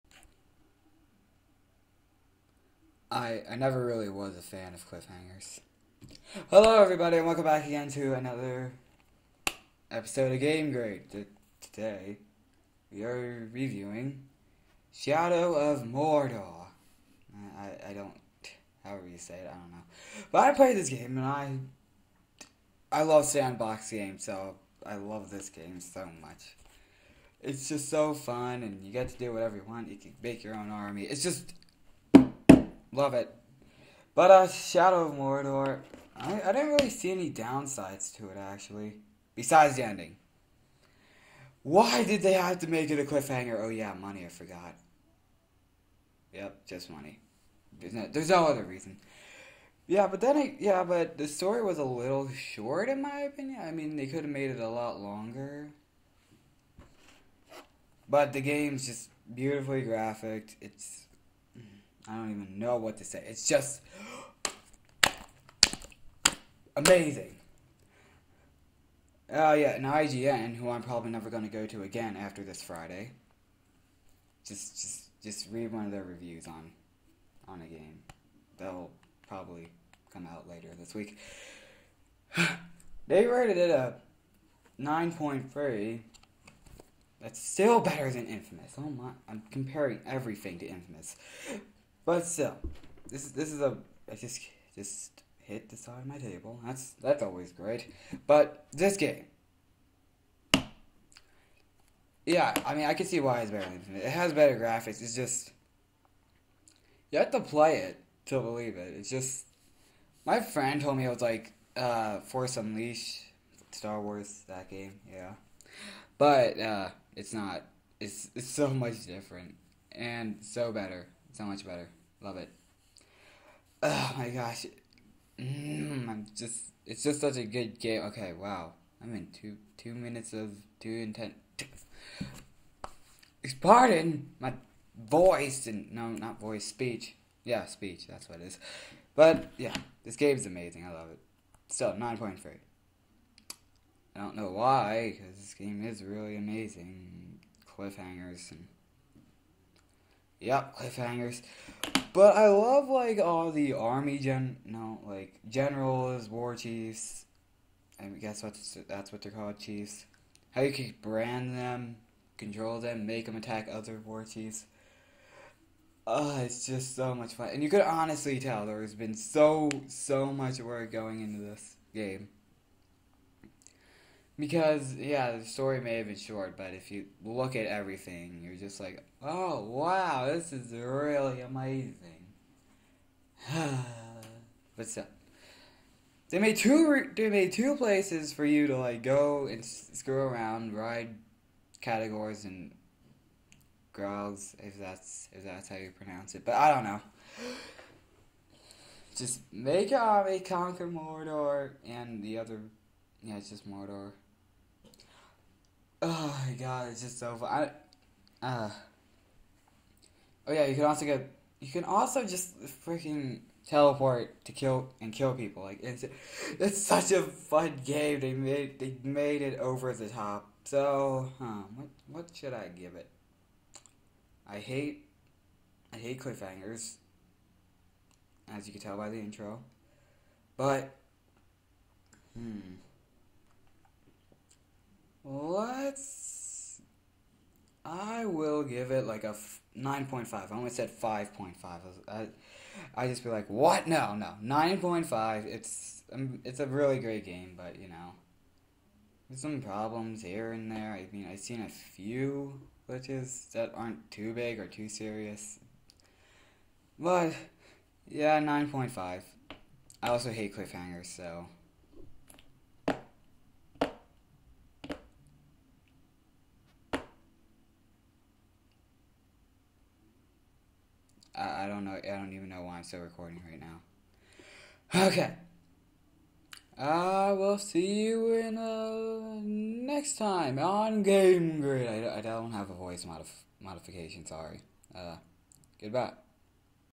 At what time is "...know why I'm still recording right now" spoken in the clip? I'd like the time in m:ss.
4:32.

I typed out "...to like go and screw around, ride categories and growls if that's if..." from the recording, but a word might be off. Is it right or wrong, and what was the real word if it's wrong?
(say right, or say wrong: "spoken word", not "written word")
right.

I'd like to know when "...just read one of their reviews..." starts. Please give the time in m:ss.
1:15.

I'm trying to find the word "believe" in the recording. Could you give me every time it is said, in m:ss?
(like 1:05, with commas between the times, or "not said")
1:48.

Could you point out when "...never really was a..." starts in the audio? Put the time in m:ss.
0:03.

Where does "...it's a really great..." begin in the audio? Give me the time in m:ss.
4:06.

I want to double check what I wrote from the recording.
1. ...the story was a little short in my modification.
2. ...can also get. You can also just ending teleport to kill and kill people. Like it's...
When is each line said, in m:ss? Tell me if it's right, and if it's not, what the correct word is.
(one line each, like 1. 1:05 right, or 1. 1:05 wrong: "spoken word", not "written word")
1. 0:51 wrong: "opinion", not "modification"
2. 3:30 wrong: "freaking", not "ending".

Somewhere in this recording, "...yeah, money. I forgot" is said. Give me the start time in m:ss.
0:43.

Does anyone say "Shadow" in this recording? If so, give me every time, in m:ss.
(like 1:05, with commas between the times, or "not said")
0:14, 0:34.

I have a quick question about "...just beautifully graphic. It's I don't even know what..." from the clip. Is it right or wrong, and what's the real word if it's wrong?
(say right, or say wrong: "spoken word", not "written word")
right.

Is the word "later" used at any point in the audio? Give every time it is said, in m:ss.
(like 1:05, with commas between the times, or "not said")
1:20.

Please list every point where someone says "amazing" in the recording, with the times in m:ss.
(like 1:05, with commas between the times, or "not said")
1:06, 2:20, 2:26, 3:01.